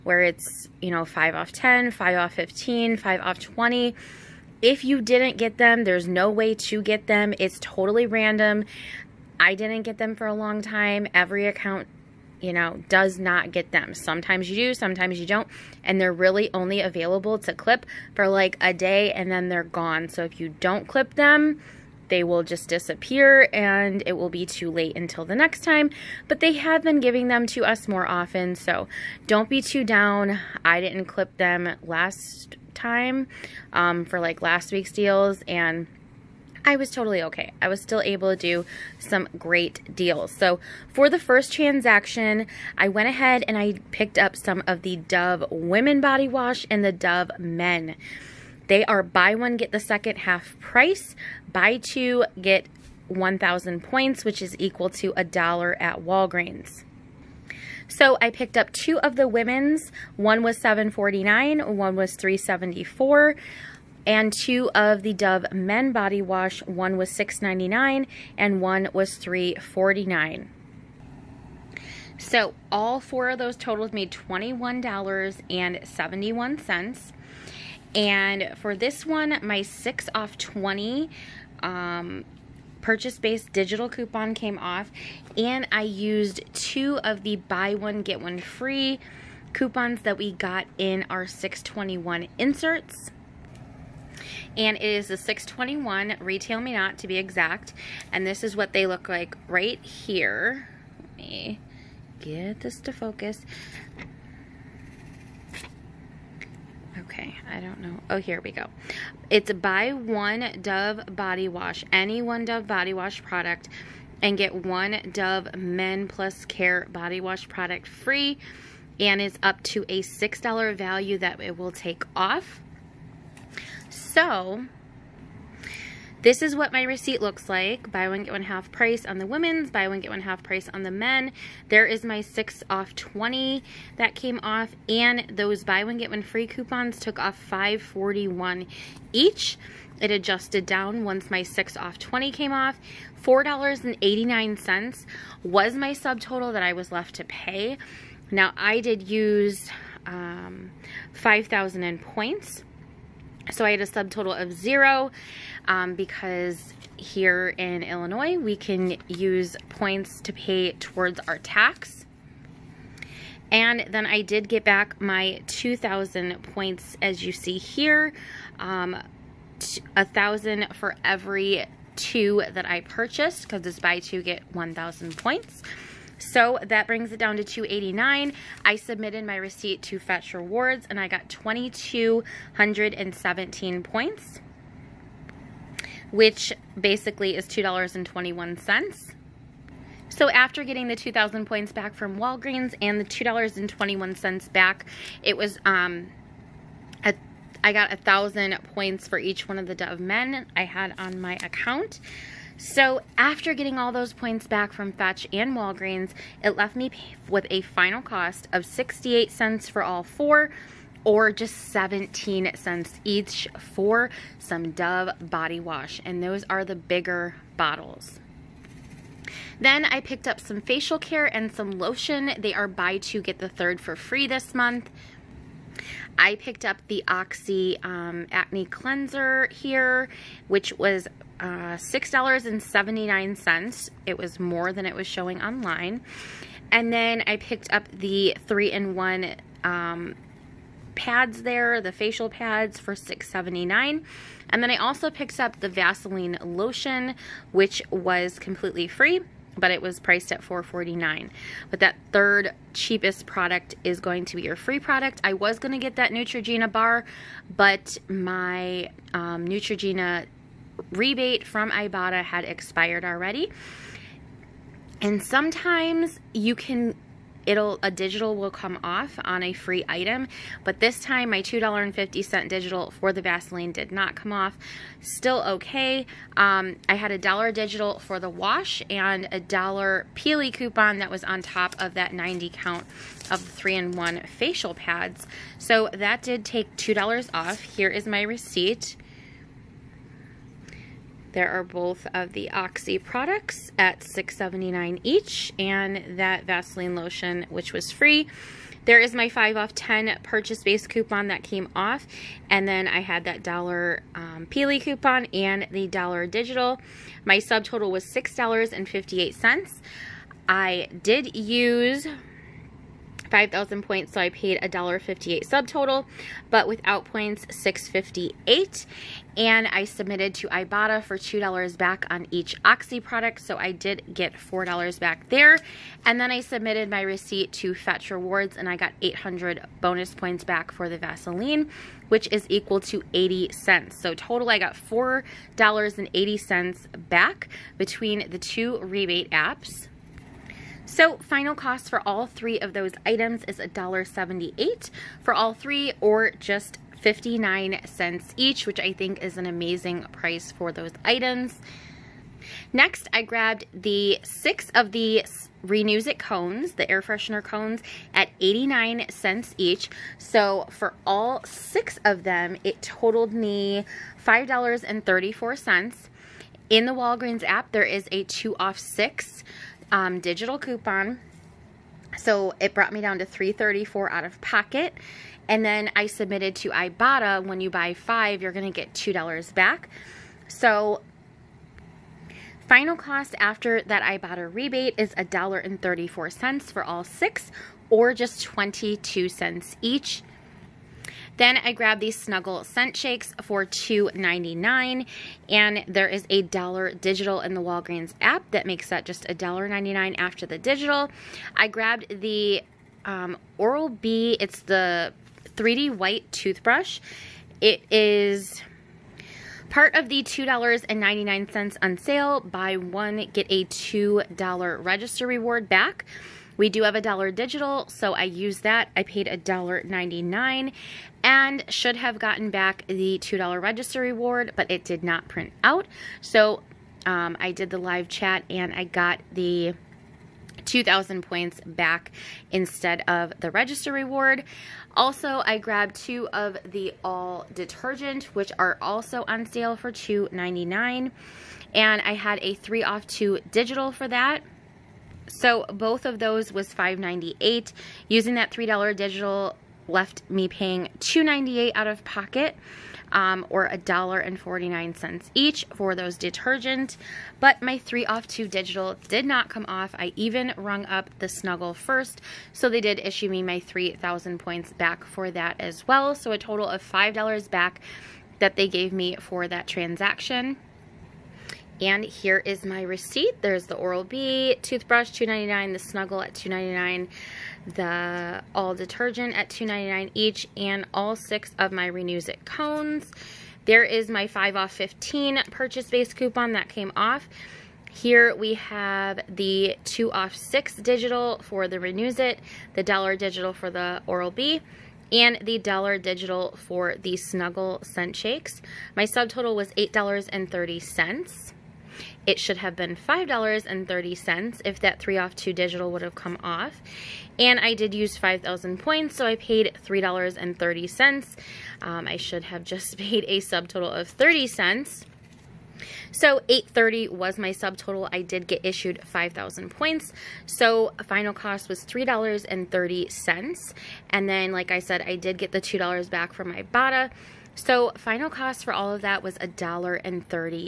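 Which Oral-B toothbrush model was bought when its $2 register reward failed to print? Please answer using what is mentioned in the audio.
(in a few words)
3D White.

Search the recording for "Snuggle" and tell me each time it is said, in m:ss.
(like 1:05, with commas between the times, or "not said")
6:32, 7:41, 7:55, 8:17.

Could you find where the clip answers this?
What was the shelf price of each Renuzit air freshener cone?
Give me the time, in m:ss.
5:58.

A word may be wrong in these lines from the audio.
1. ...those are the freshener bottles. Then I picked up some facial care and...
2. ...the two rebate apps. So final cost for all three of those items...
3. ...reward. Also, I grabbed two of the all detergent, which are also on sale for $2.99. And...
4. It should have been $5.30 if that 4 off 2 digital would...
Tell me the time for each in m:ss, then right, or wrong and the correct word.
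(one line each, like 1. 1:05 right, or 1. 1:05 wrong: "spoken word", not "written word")
1. 3:36 wrong: "bigger", not "freshener"
2. 5:38 right
3. 7:13 right
4. 8:22 wrong: "3", not "4".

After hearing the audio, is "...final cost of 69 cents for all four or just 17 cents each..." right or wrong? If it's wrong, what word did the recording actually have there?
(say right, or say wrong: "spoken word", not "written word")
wrong: "68", not "69".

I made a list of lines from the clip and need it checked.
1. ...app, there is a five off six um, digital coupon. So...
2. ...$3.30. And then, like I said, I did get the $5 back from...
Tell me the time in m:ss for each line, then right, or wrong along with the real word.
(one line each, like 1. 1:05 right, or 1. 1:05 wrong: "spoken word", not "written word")
1. 6:07 wrong: "two", not "five"
2. 8:41 wrong: "2", not "5".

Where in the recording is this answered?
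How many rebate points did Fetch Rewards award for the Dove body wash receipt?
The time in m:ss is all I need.
3:01.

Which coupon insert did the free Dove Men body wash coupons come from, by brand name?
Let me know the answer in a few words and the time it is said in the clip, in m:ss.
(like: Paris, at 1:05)
RetailMeNot, at 1:36.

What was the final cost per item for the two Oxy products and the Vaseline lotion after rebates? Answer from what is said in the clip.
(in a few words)
59 cents.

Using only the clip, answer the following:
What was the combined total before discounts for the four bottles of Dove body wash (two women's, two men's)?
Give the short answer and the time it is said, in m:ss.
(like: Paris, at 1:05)
$21.71, at 1:14.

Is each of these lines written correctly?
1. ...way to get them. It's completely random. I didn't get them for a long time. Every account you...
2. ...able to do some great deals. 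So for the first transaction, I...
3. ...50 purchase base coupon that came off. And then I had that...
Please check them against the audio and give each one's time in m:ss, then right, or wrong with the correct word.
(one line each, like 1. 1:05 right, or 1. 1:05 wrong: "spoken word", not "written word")
1. 0:06 wrong: "totally", not "completely"
2. 0:38 right
3. 4:59 wrong: "10", not "50".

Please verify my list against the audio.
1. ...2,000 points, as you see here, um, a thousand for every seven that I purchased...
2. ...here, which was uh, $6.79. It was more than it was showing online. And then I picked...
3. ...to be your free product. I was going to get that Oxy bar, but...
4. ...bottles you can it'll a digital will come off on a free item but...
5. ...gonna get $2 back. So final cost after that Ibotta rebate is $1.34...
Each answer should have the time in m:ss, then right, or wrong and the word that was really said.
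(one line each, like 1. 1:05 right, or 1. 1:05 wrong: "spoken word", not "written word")
1. 2:45 wrong: "two", not "seven"
2. 3:49 right
3. 4:14 wrong: "Neutrogena", not "Oxy"
4. 4:25 wrong: "sometimes", not "bottles"
5. 6:18 right.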